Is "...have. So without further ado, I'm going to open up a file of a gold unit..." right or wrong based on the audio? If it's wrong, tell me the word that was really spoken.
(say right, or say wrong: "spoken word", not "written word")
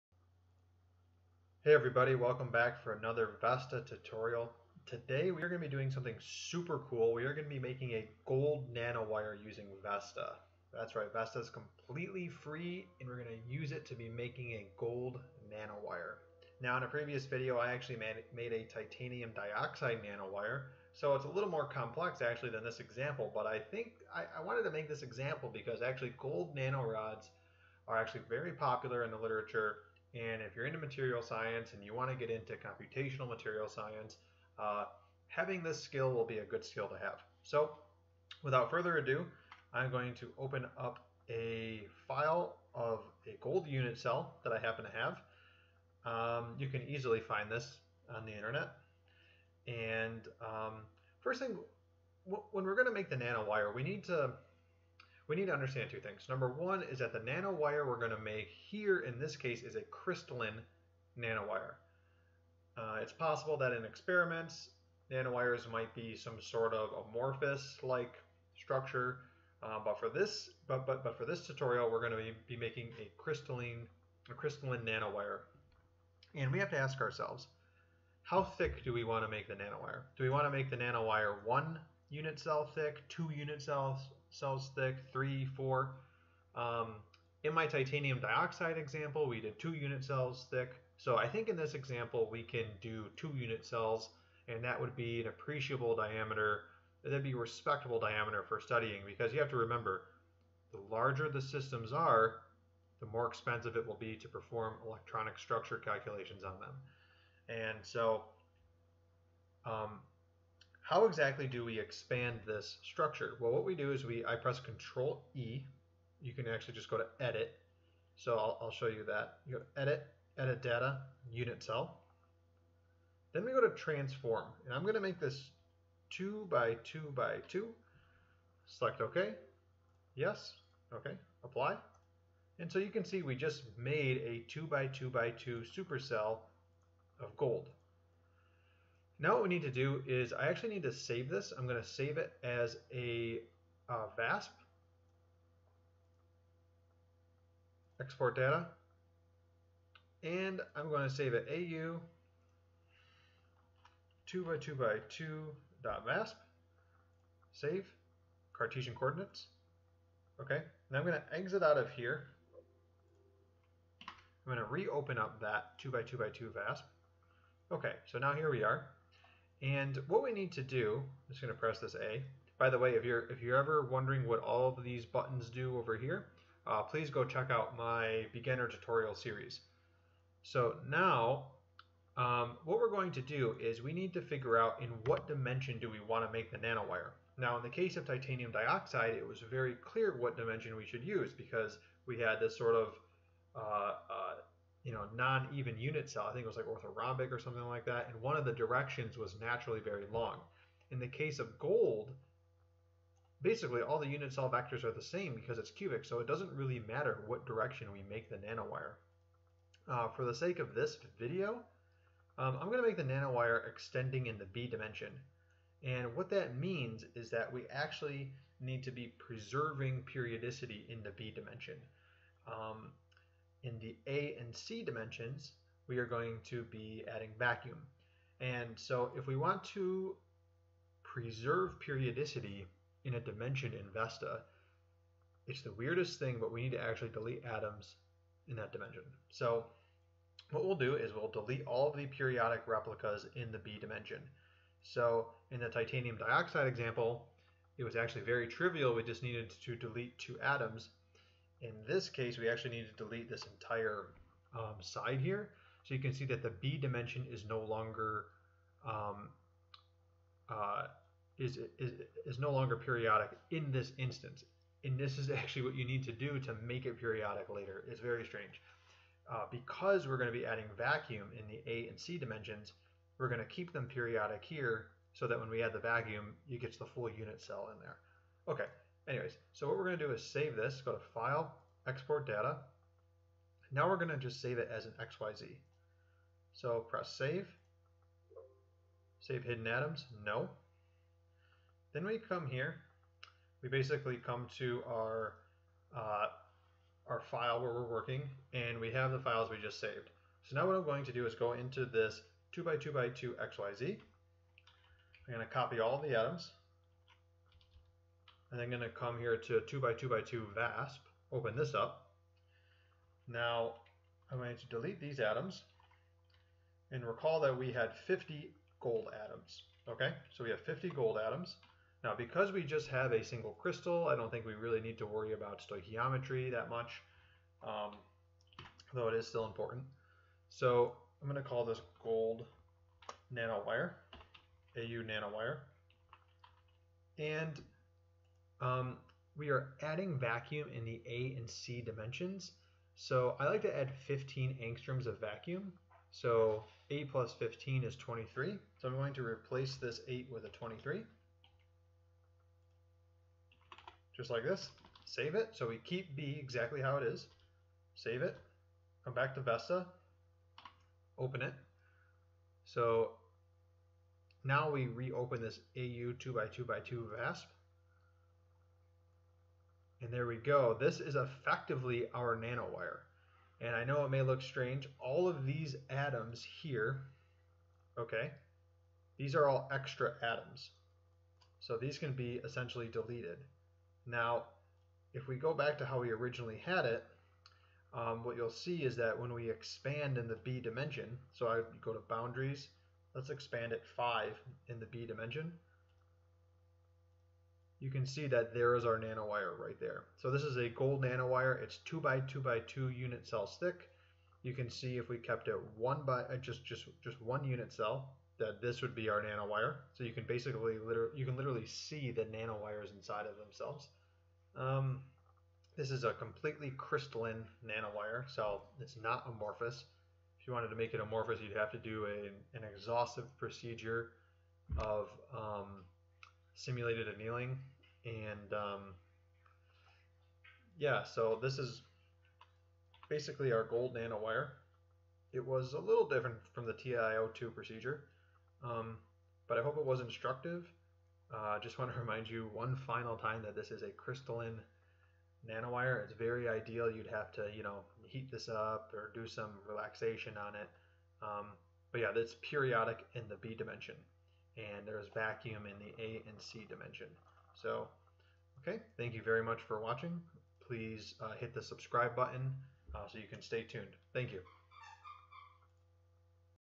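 right.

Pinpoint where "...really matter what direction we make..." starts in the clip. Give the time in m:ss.
3:26.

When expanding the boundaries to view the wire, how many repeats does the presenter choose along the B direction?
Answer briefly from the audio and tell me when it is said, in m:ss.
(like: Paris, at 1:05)
5, at 6:33.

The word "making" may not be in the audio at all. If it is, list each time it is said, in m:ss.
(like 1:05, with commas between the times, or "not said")
0:07, 0:14, 1:12.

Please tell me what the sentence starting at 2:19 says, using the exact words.
Now what we need to do is I actually need to save this.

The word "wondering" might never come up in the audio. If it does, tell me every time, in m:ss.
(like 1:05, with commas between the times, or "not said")
2:53.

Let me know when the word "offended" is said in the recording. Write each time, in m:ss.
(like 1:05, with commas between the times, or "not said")
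not said.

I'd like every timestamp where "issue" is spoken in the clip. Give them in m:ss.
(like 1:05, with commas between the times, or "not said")
not said.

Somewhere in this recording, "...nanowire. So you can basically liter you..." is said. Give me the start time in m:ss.
6:49.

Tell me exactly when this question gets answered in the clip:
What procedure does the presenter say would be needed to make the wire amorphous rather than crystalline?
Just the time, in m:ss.
7:06.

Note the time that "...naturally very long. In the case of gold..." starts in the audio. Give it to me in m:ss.
3:19.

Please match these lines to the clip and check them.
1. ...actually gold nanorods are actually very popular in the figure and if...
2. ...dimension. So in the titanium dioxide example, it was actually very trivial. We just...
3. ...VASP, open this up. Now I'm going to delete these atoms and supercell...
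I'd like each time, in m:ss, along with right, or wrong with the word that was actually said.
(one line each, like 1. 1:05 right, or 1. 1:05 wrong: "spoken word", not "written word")
1. 0:25 wrong: "literature", not "figure"
2. 4:03 right
3. 5:10 wrong: "recall", not "supercell".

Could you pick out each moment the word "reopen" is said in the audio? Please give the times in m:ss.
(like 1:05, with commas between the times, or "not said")
2:44, 6:04.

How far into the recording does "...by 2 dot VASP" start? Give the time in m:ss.
2:34.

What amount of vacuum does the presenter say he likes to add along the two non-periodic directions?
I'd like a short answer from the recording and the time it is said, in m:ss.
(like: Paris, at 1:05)
15 angstroms, at 5:44.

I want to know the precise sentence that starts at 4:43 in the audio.
Now we're going to just save it as an XYZ.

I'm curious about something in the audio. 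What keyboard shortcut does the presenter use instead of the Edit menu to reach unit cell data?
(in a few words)
Control E.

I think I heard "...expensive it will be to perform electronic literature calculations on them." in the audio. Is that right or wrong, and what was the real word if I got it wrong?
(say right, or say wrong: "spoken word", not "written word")
wrong: "structure", not "literature".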